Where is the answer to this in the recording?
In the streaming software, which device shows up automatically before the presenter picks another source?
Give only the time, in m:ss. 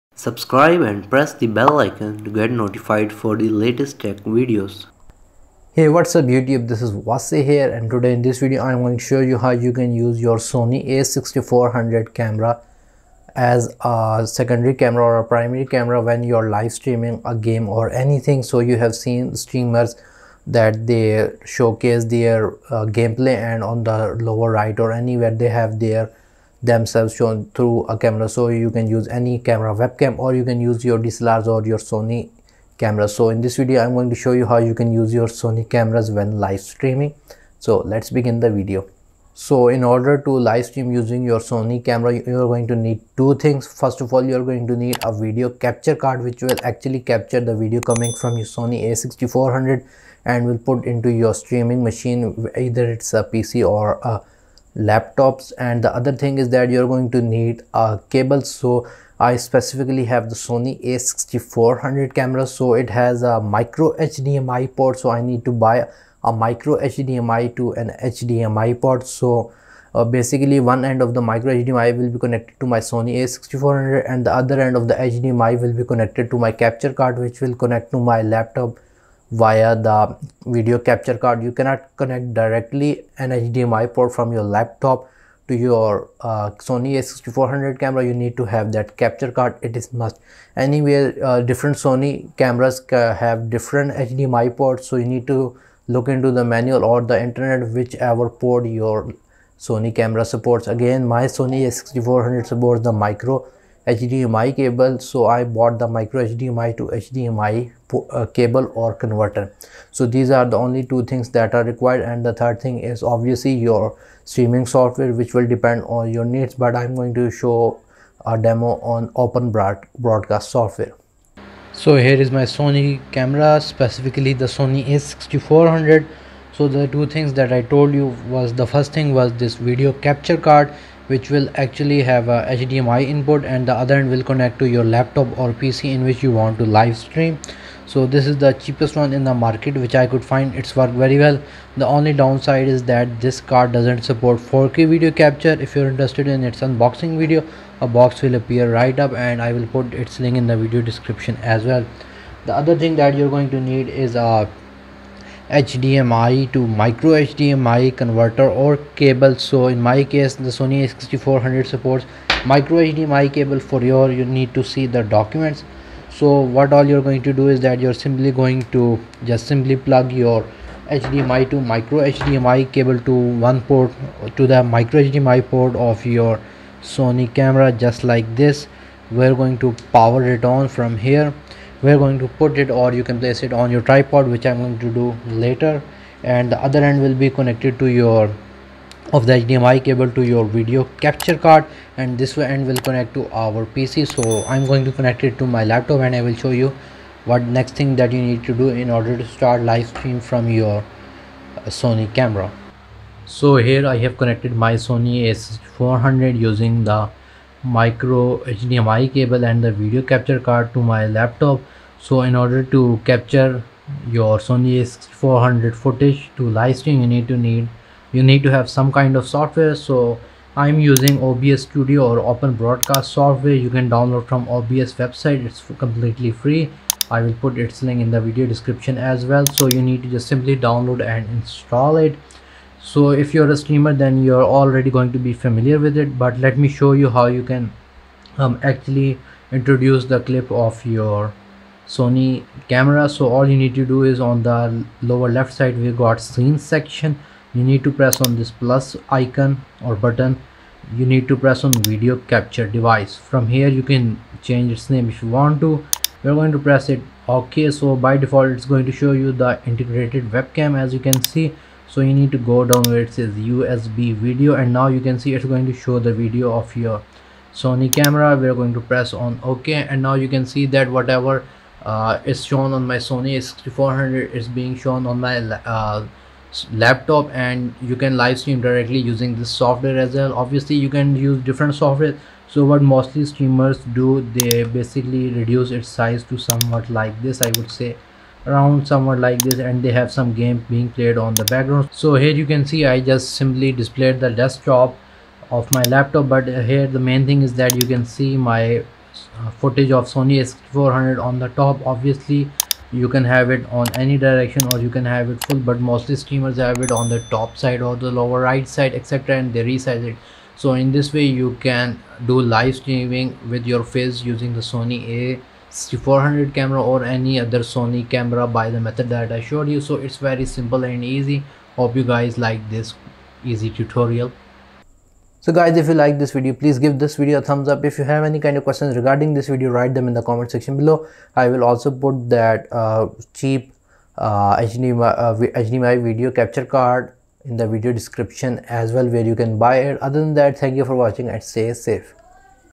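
4:19.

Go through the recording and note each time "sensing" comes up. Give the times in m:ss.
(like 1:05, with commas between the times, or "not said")
not said.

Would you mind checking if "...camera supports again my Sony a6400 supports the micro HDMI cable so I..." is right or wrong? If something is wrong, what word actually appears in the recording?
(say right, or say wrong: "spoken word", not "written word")
right.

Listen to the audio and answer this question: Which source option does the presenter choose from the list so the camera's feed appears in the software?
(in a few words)
USB video.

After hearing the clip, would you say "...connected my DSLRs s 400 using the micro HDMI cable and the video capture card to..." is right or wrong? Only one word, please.
wrong.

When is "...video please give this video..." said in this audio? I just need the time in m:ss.
5:26.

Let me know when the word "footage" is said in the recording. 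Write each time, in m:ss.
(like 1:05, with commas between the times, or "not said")
3:35, 4:59.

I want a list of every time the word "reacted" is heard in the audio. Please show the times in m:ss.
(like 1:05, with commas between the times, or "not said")
not said.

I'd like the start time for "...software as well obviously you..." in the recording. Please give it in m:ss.
4:39.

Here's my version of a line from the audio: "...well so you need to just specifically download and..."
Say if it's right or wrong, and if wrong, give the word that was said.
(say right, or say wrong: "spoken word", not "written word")
wrong: "simply", not "specifically".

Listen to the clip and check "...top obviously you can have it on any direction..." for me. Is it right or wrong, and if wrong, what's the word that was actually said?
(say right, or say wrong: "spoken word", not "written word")
right.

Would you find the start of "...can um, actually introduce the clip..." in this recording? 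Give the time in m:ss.
3:57.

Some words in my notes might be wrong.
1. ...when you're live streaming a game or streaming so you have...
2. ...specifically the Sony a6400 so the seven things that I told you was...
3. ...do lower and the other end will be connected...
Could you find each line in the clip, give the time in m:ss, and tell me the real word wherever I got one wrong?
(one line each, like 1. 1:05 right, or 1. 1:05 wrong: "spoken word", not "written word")
1. 0:16 wrong: "anything", not "streaming"
2. 2:03 wrong: "two", not "seven"
3. 3:04 wrong: "later", not "lower".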